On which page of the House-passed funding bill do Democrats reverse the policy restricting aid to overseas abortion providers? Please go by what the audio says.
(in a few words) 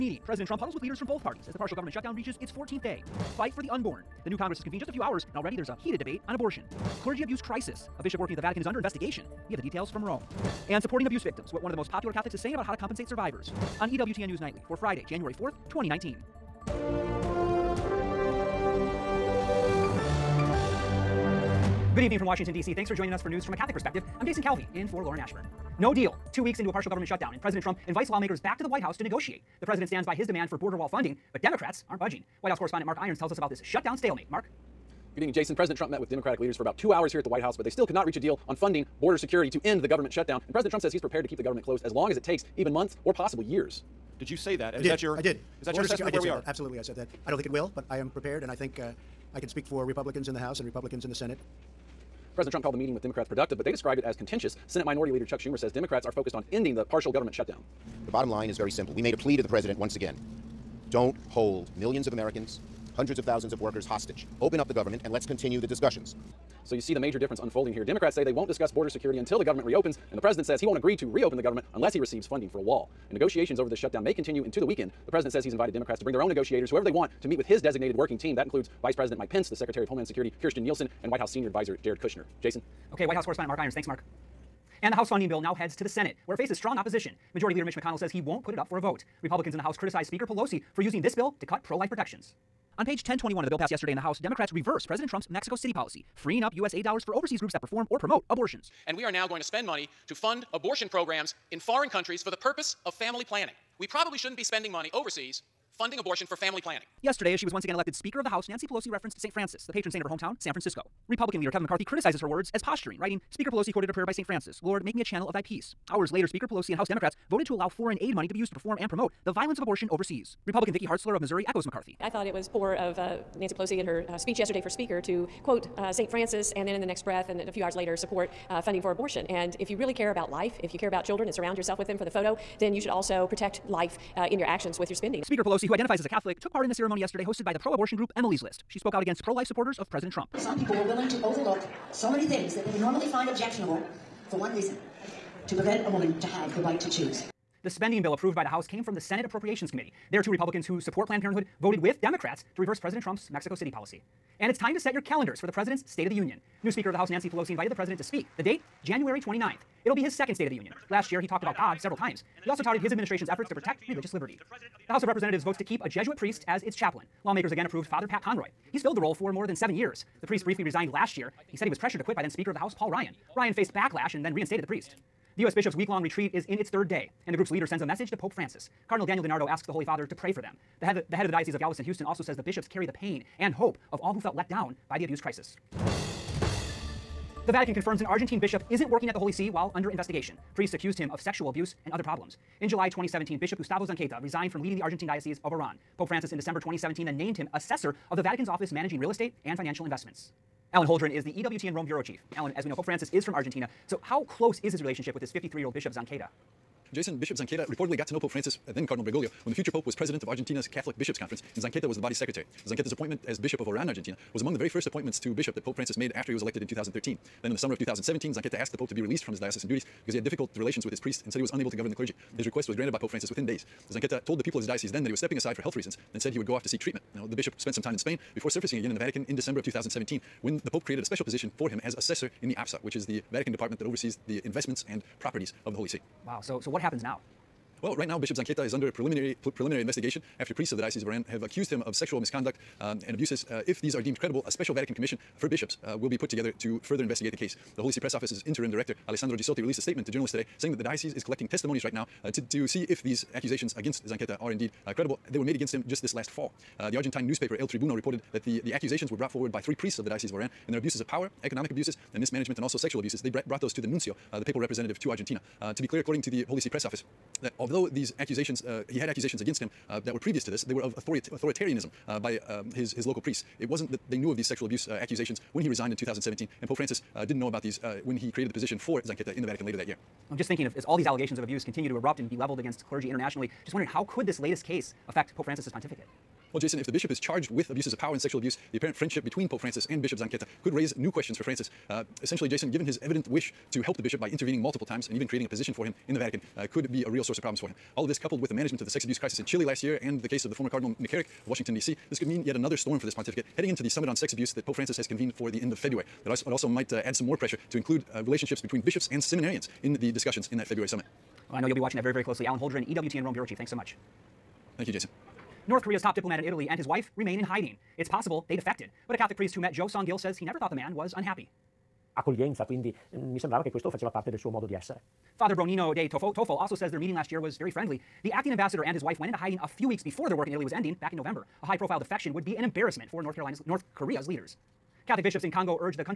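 1021.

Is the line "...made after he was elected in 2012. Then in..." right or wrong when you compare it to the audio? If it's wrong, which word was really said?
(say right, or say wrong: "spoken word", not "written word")
wrong: "2013", not "2012".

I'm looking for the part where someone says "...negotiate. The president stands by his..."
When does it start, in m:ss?
0:29.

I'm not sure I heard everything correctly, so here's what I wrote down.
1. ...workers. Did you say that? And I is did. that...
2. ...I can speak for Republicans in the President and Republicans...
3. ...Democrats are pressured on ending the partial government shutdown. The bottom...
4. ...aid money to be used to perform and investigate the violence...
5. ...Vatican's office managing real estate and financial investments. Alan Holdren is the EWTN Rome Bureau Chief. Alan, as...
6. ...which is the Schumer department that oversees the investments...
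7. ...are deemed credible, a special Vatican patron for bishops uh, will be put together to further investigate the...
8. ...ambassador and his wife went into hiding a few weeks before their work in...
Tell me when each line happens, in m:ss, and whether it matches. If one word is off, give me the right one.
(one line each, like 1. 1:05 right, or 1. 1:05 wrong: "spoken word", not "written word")
1. 0:43 wrong: "years", not "workers"
2. 0:49 wrong: "House", not "President"
3. 0:55 wrong: "focused", not "pressured"
4. 1:57 wrong: "promote", not "investigate"
5. 3:18 right
6. 3:52 wrong: "Vatican", not "Schumer"
7. 4:03 wrong: "commission", not "patron"
8. 5:28 right.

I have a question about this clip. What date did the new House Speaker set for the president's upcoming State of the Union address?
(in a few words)
January 29th.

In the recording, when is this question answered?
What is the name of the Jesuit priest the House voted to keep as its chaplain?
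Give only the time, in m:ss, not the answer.
2:47.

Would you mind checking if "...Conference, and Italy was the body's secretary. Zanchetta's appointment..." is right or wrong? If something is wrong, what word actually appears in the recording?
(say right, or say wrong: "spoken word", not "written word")
wrong: "Zanchetta", not "Italy".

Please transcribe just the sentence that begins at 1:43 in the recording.
We probably shouldn't be spending money overseas funding abortion for family planning.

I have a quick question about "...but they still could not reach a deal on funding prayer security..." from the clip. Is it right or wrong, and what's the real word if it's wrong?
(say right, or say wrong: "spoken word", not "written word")
wrong: "border", not "prayer".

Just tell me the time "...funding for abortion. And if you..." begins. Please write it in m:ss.
2:08.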